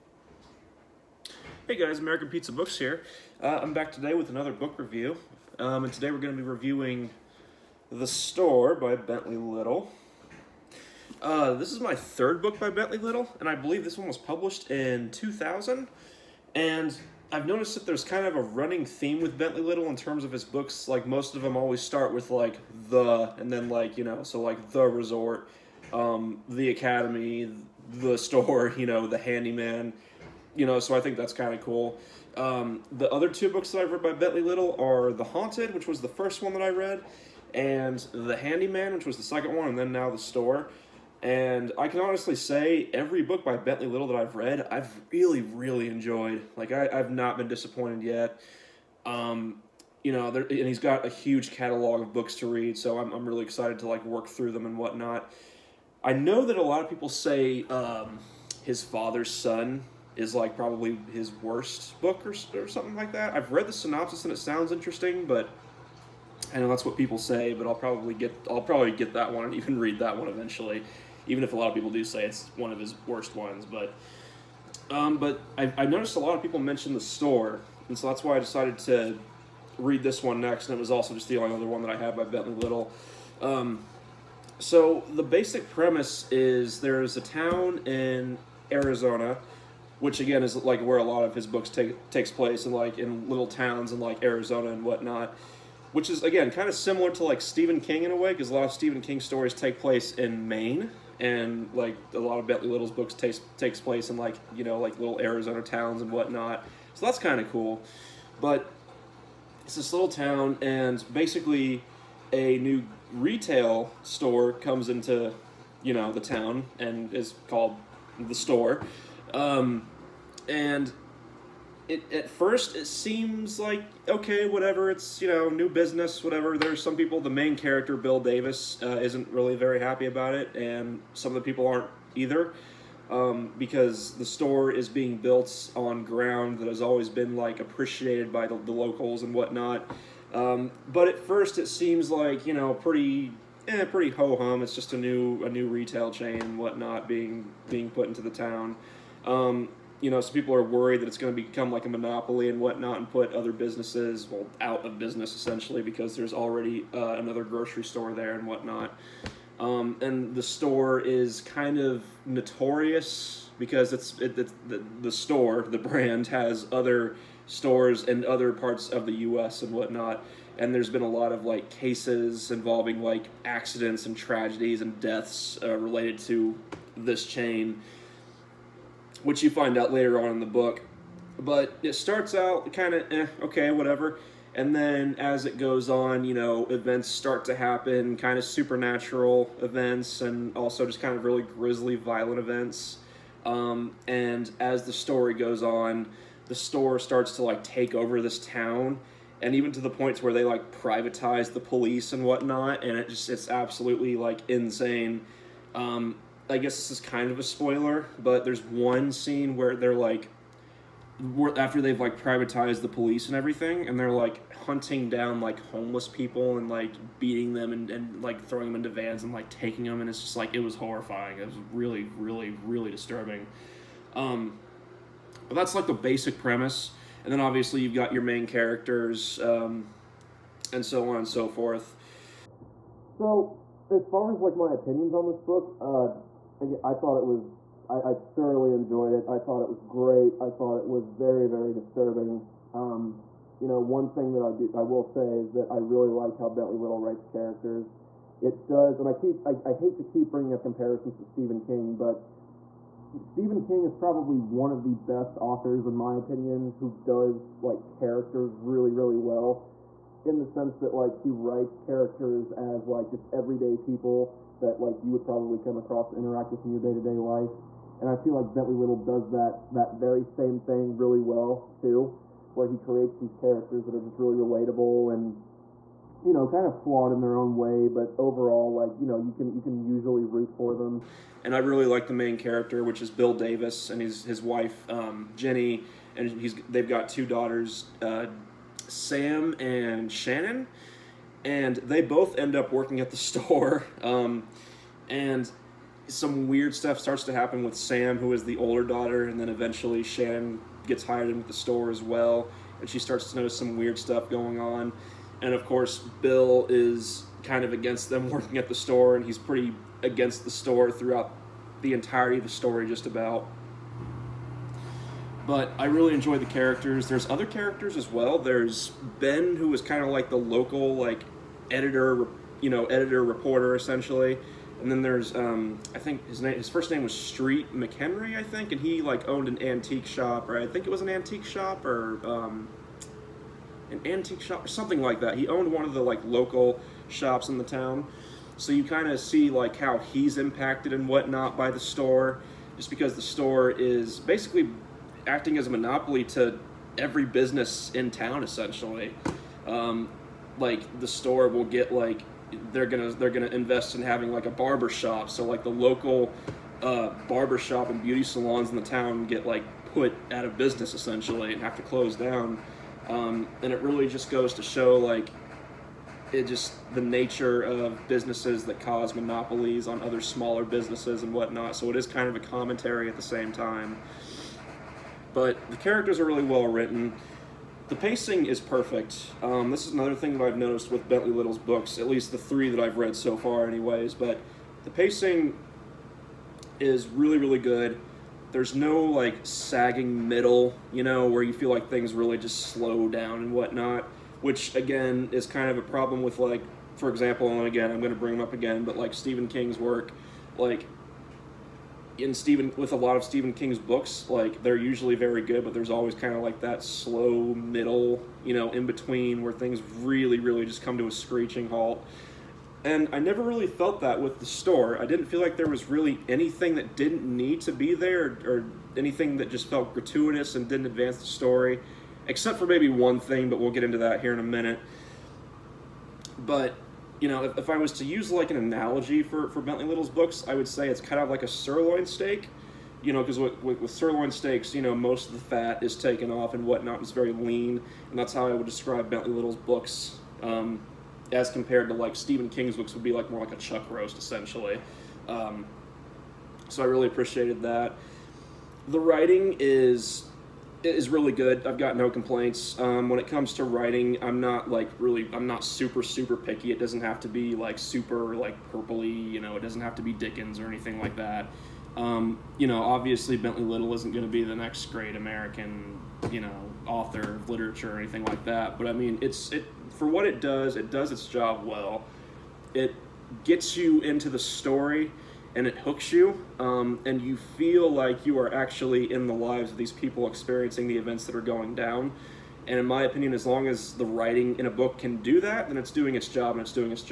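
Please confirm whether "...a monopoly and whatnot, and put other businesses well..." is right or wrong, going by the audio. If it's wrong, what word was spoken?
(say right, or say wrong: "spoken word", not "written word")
right.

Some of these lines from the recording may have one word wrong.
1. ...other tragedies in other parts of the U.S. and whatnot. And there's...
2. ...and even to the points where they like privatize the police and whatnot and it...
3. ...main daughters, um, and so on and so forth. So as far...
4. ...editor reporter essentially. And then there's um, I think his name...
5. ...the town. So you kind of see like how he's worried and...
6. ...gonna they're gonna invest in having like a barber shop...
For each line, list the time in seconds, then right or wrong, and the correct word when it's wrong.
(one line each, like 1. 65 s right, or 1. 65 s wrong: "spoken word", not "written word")
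1. 166 s wrong: "stores", not "tragedies"
2. 199 s right
3. 228 s wrong: "characters", not "daughters"
4. 322 s right
5. 337 s wrong: "impacted", not "worried"
6. 352 s right.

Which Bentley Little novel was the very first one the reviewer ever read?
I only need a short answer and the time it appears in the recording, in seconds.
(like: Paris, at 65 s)
The Haunted, at 35 s.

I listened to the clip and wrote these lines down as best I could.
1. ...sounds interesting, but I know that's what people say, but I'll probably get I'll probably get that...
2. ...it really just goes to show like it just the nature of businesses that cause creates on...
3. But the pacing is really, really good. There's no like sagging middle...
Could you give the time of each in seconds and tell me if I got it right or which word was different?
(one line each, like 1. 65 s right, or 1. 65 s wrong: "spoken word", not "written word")
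1. 64 s right
2. 363 s wrong: "monopolies", not "creates"
3. 384 s right.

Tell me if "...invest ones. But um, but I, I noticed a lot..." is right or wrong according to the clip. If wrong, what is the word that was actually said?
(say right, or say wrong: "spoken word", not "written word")
wrong: "worst", not "invest".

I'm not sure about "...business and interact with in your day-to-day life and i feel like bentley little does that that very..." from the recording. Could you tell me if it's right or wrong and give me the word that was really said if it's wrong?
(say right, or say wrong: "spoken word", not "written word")
wrong: "across", not "business".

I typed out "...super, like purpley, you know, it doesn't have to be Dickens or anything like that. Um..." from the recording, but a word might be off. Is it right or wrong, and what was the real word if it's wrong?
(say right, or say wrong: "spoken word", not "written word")
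right.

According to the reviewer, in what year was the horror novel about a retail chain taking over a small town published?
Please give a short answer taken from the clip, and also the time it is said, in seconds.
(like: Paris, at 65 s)
2000, at 15 s.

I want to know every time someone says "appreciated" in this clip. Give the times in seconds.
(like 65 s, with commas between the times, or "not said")
137 s, 447 s.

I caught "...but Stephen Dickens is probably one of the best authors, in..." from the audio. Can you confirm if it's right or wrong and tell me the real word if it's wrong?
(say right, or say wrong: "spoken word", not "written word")
wrong: "King", not "Dickens".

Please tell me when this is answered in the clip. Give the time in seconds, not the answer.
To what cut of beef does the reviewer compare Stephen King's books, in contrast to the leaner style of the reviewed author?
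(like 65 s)
443 s.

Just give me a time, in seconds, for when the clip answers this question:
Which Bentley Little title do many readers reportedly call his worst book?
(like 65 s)
58 s.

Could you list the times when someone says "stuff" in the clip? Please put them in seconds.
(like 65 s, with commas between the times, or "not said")
296 s, 303 s.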